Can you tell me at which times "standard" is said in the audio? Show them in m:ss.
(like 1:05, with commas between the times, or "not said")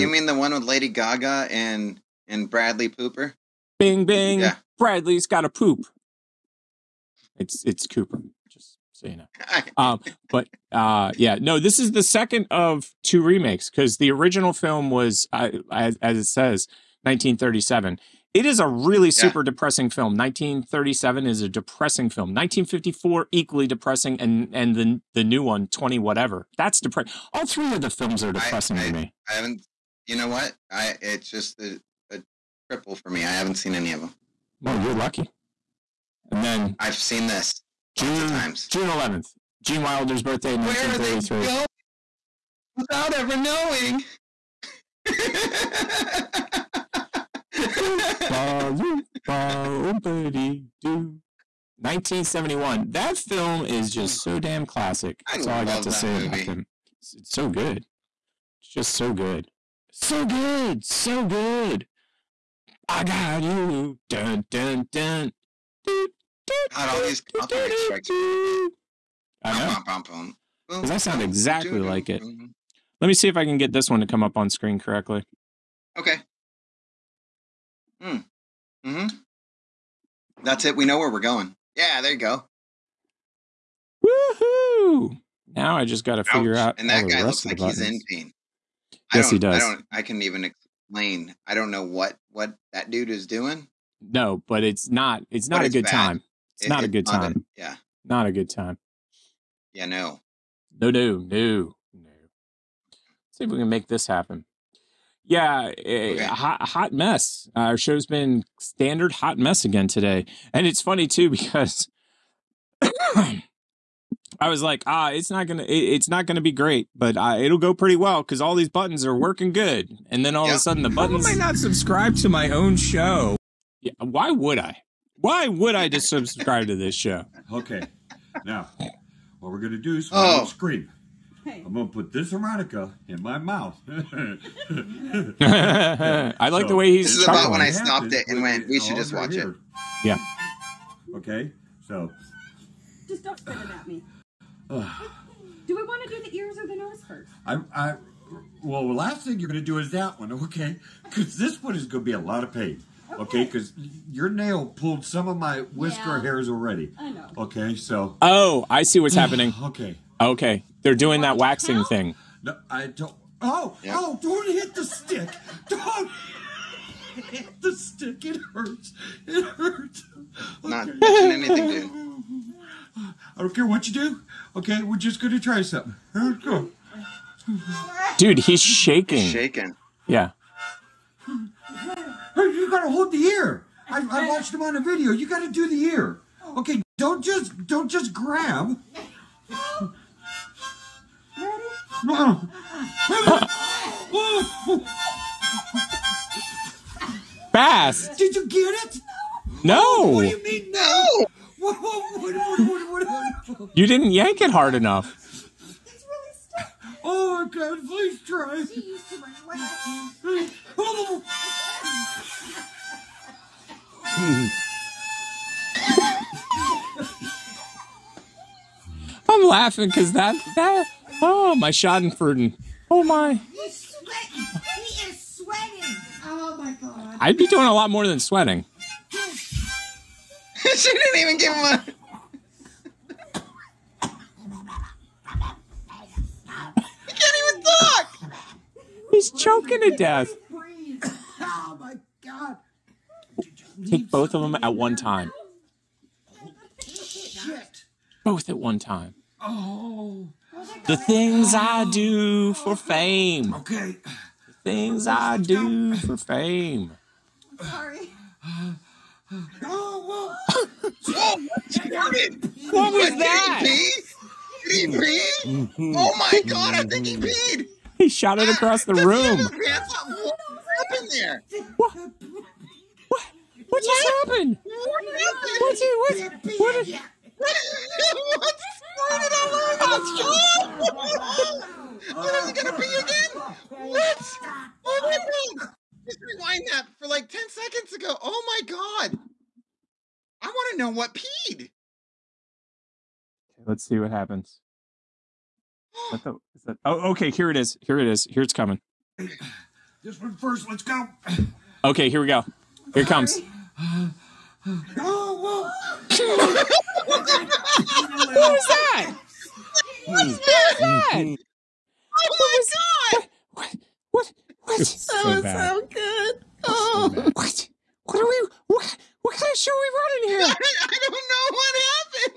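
1:48.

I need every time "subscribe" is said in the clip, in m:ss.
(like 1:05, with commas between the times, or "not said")
2:01, 2:06.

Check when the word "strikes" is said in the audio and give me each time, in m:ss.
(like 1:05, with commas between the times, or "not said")
1:07.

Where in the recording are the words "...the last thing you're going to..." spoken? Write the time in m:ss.
2:28.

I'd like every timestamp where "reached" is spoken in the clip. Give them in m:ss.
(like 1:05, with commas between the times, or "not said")
not said.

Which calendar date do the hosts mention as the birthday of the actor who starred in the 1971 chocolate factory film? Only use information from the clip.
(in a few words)
June 11th.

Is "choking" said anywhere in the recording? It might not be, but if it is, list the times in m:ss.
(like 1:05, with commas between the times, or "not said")
3:59.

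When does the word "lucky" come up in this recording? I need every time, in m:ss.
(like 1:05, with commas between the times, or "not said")
0:34.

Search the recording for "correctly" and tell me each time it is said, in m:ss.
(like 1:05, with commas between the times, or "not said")
1:14.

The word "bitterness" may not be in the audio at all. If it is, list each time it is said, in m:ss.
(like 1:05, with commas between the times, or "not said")
not said.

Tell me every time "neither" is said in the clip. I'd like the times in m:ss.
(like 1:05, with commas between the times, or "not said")
not said.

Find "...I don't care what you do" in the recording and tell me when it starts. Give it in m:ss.
2:53.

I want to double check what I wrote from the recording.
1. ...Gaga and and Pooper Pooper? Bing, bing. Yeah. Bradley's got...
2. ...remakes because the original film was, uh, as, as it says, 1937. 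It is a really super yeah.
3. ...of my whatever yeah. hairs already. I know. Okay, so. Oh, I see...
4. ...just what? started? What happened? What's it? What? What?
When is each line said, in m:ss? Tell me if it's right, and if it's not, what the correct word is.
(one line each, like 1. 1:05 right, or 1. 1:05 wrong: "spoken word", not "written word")
1. 0:00 wrong: "Bradley", not "Pooper"
2. 0:13 right
3. 2:35 wrong: "whisker", not "whatever"
4. 4:33 wrong: "happened", not "started".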